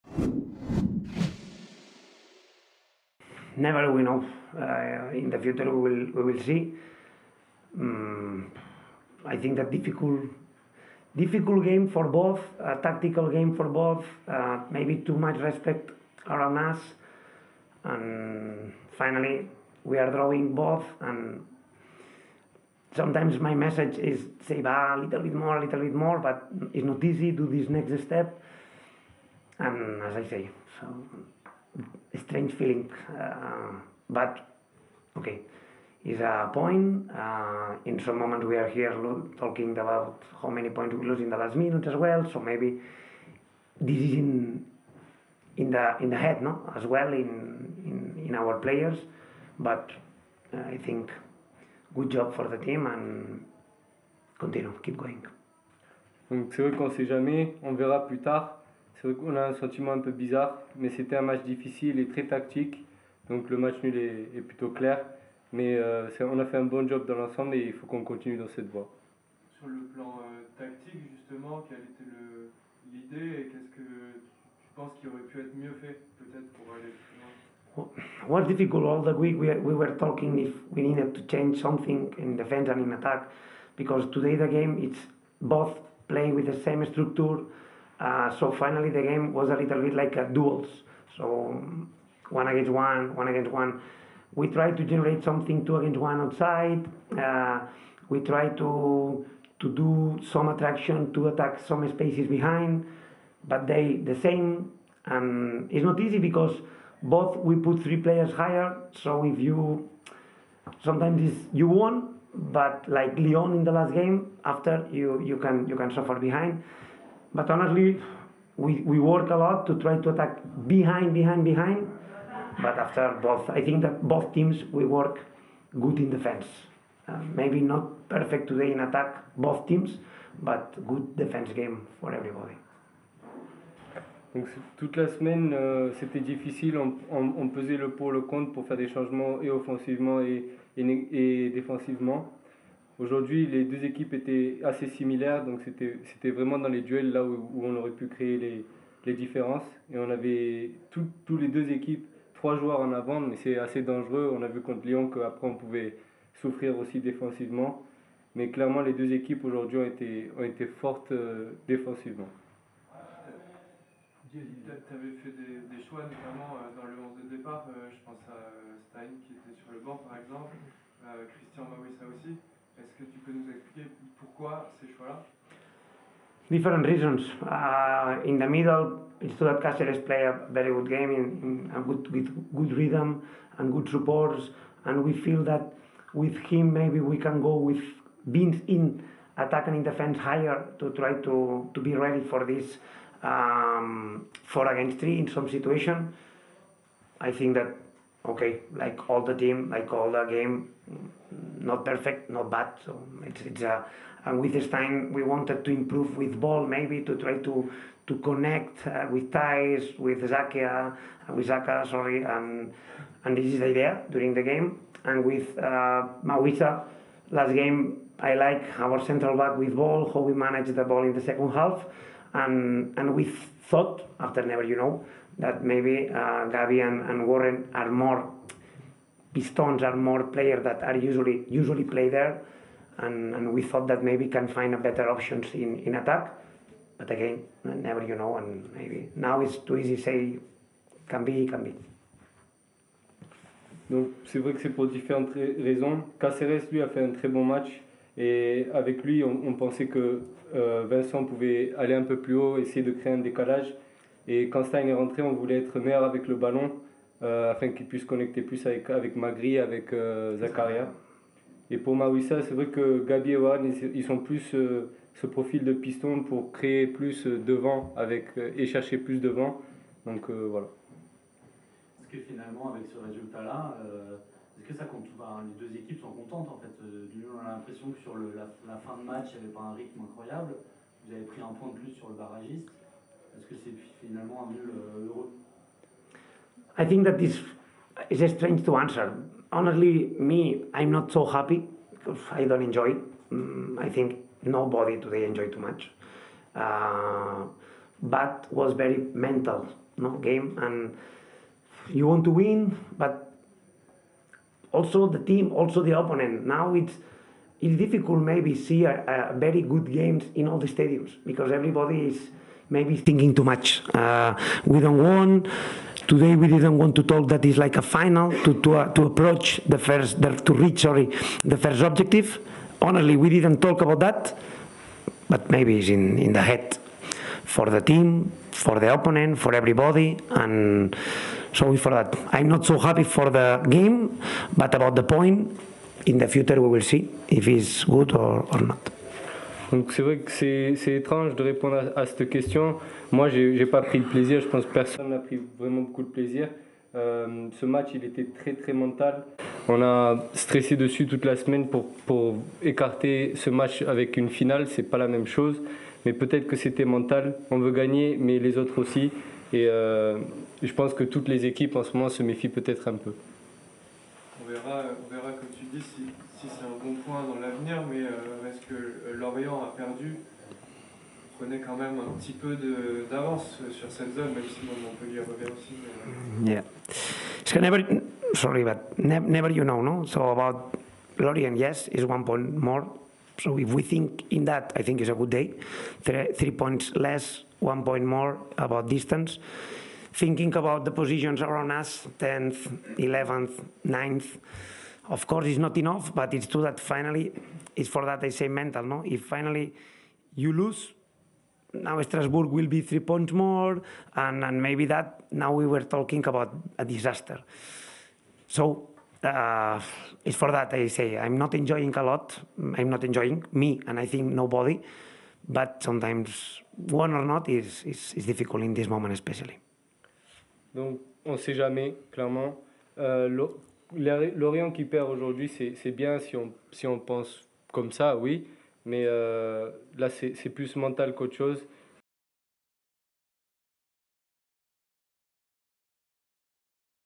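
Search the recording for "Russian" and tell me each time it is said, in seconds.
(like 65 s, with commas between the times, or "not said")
not said.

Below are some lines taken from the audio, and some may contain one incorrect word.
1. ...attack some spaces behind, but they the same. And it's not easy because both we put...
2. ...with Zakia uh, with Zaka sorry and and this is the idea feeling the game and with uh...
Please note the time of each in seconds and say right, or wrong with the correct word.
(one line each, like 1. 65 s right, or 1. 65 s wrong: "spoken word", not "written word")
1. 101 s right
2. 209 s wrong: "during", not "feeling".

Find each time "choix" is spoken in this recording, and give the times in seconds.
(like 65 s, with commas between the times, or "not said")
165 s, 174 s.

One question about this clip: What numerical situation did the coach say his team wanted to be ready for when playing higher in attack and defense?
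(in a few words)
four against three.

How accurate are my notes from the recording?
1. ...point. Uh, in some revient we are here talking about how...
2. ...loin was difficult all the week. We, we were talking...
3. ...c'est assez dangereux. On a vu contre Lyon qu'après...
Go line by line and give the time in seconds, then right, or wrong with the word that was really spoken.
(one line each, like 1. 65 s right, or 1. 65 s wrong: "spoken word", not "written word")
1. 36 s wrong: "moment", not "revient"
2. 77 s right
3. 153 s right.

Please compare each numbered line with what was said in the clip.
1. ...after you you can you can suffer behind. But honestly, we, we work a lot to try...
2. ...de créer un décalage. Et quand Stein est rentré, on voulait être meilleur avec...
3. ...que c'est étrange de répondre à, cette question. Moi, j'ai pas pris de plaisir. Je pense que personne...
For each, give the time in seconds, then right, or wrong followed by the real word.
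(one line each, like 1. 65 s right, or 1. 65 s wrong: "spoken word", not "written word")
1. 114 s right
2. 252 s right
3. 340 s right.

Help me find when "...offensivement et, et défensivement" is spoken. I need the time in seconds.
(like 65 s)
139 s.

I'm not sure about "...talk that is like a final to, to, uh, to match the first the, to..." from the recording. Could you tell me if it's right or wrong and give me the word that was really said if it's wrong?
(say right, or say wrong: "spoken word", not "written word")
wrong: "approach", not "match".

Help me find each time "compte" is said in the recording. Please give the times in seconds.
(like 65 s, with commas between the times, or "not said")
274 s.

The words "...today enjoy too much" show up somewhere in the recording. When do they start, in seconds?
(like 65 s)
294 s.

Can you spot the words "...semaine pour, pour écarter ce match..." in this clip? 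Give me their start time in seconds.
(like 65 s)
351 s.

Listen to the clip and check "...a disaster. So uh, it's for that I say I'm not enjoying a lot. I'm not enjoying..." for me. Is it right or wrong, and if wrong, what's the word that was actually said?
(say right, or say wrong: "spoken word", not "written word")
right.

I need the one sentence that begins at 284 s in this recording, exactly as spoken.
Euh, I think that this is strange to answer.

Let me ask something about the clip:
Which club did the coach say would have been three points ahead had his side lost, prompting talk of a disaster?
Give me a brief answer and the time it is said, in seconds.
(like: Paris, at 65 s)
Strasbourg, at 402 s.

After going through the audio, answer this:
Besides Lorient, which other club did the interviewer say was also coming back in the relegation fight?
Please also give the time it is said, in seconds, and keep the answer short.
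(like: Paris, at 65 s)
Montpellier, at 374 s.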